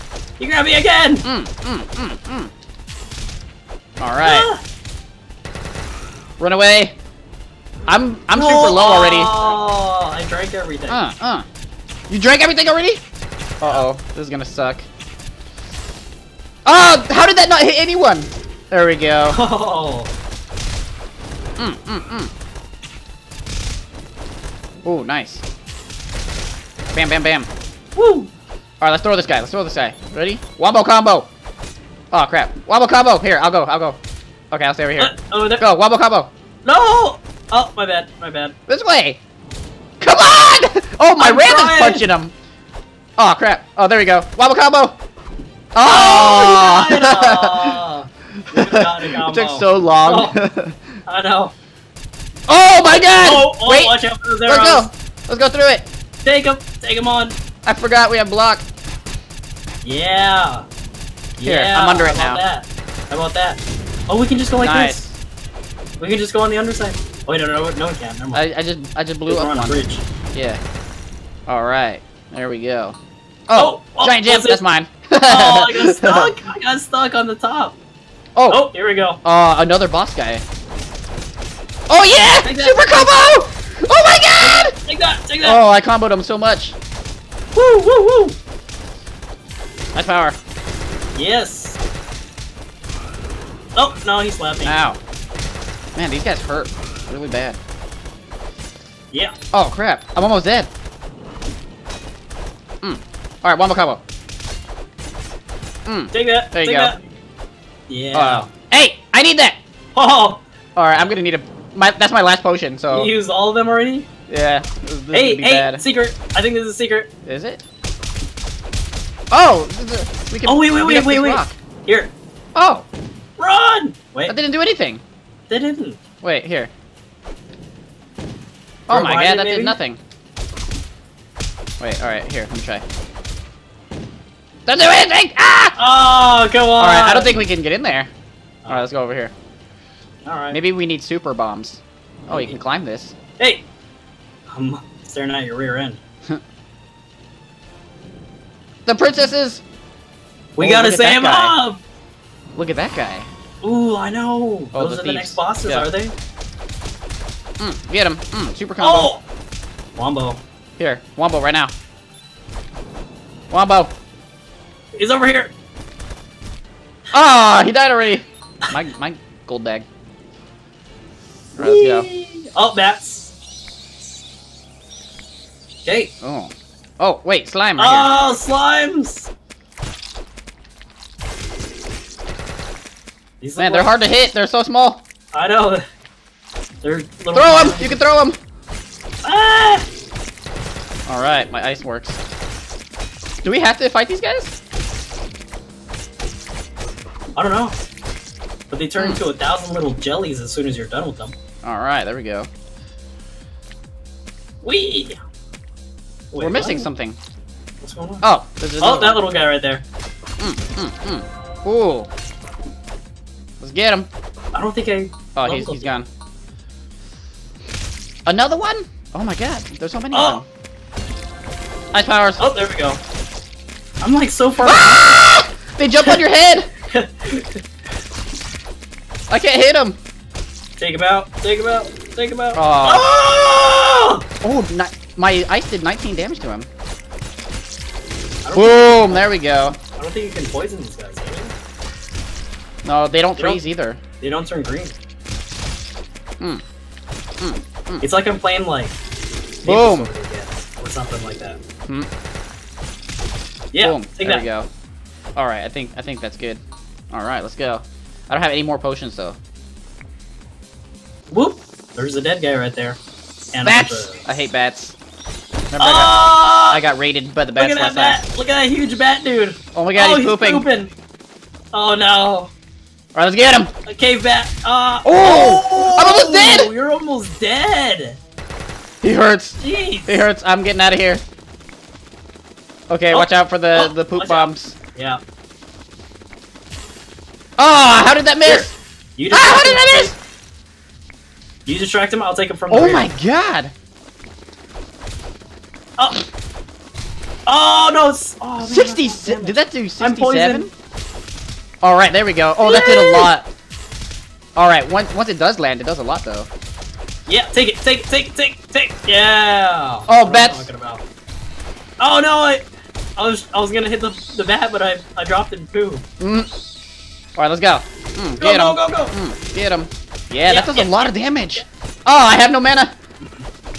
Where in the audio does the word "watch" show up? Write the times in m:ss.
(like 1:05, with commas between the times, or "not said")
0:53, 4:43.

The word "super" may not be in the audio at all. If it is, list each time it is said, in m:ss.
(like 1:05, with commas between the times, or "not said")
0:08, 1:22, 2:21, 2:38.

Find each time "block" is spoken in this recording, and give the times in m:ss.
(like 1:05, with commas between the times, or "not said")
0:58.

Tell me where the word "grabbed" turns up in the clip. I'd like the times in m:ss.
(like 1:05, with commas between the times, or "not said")
0:00.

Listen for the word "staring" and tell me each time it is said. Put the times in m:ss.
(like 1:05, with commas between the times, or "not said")
2:25.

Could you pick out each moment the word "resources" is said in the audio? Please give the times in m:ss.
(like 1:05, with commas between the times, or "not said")
not said.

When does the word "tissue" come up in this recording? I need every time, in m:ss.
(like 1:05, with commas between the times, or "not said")
not said.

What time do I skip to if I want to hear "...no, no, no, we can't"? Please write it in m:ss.
1:07.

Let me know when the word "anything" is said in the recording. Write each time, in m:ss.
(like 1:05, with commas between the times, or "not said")
2:04, 2:14.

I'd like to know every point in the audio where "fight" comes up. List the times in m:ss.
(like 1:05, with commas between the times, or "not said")
3:13.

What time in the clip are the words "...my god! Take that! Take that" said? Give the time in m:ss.
1:24.